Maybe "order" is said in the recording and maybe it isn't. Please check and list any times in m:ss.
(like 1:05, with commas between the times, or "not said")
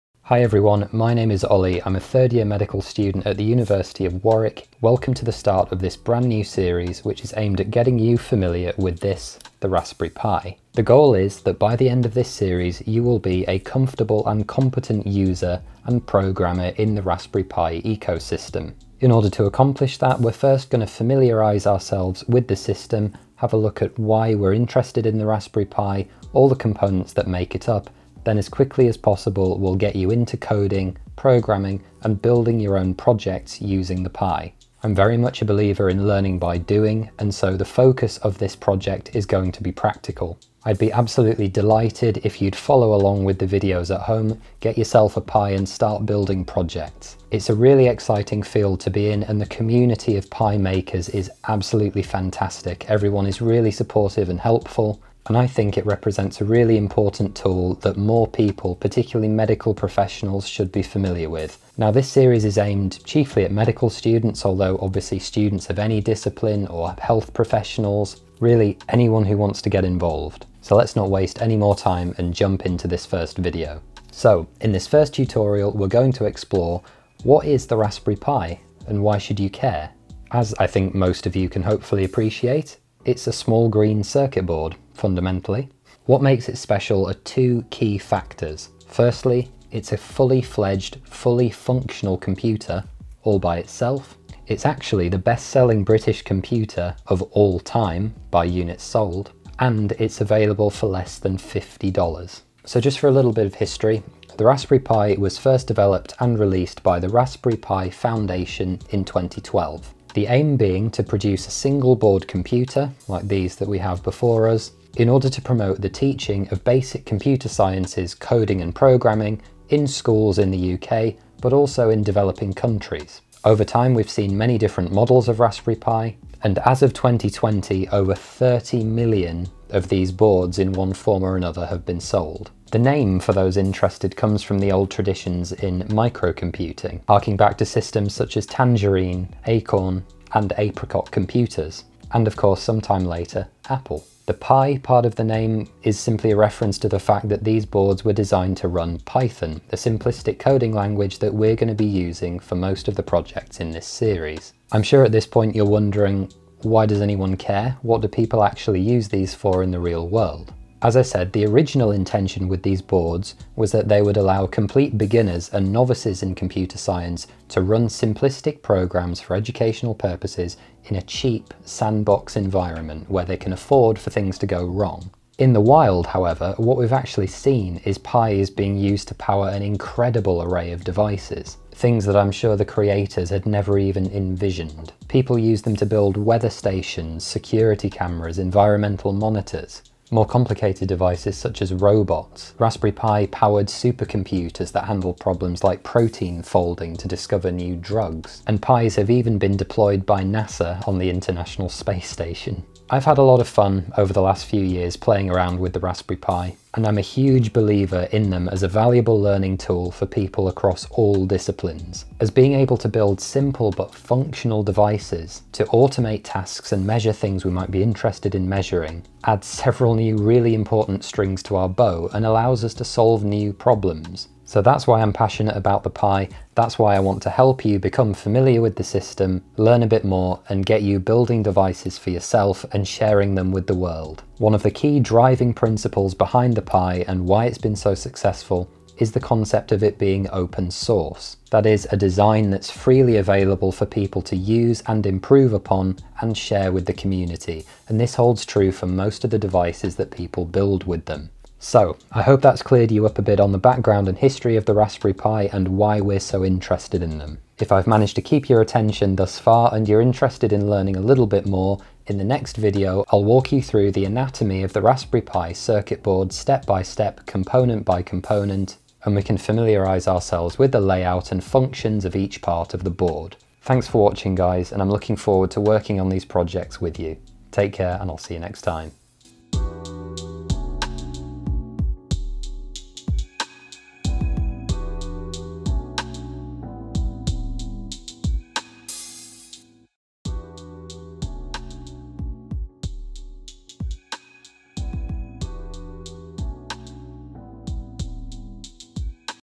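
0:19, 1:55.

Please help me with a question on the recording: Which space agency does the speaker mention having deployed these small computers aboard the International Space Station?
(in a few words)
NASA.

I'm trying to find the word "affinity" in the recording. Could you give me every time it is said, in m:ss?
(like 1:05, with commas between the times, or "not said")
not said.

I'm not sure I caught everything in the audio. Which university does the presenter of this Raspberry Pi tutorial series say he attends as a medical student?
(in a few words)
University of Warwick.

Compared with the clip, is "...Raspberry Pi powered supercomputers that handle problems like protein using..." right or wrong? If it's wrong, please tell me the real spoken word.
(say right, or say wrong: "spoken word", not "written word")
wrong: "folding", not "using".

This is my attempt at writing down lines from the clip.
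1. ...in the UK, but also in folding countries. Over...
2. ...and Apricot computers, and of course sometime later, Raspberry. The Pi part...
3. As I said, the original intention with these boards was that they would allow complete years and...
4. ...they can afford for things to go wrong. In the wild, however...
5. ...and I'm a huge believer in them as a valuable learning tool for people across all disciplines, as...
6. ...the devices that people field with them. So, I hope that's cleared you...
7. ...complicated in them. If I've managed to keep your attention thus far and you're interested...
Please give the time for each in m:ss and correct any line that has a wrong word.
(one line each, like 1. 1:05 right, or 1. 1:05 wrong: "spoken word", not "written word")
1. 2:00 wrong: "developing", not "folding"
2. 2:20 wrong: "Apple", not "Raspberry"
3. 2:40 wrong: "beginners", not "years"
4. 2:53 right
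5. 3:26 right
6. 4:09 wrong: "build", not "field"
7. 4:16 wrong: "interested", not "complicated".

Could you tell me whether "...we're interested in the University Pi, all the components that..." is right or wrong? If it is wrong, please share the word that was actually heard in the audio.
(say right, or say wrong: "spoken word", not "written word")
wrong: "Raspberry", not "University".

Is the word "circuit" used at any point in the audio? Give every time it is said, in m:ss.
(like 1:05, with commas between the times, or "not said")
1:24, 4:25.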